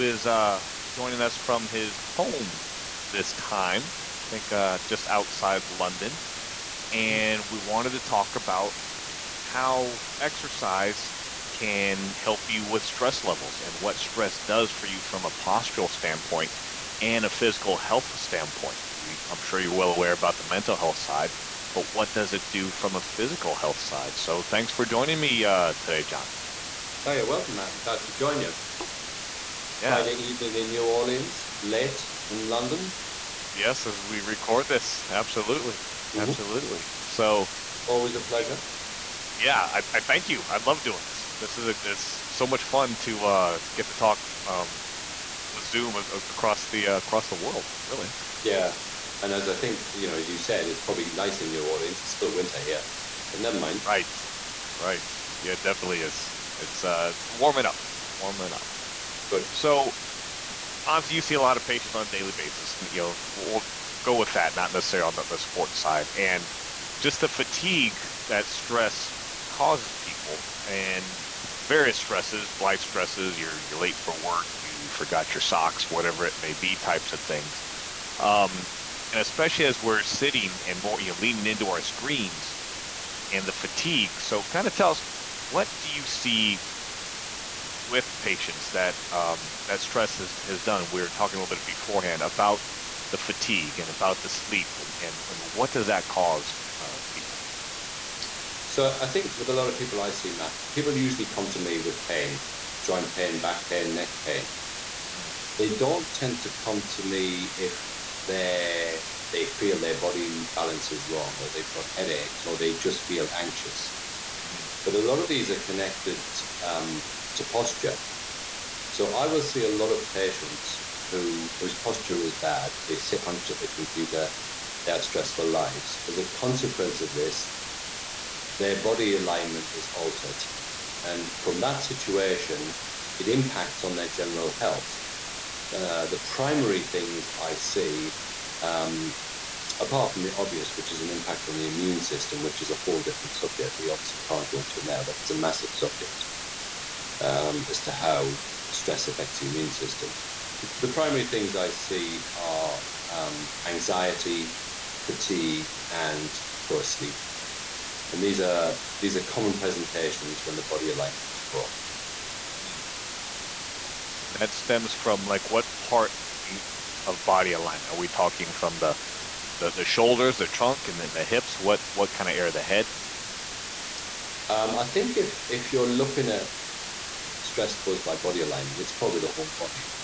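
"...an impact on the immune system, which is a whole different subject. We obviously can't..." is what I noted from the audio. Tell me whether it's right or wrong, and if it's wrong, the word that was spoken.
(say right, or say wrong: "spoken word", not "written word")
right.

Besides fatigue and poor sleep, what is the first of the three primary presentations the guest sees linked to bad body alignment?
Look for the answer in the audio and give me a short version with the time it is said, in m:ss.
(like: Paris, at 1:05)
Anxiety, at 2:33.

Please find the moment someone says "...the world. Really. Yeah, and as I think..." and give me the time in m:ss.
0:47.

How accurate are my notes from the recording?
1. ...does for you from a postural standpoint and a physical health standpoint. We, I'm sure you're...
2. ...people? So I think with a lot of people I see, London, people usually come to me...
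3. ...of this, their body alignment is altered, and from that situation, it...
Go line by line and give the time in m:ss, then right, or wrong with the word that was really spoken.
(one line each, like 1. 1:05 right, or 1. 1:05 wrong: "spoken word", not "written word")
1. 0:14 right
2. 1:37 wrong: "Matt", not "London"
3. 2:07 right.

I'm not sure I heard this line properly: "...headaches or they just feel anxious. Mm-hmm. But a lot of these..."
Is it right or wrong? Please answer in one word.
right.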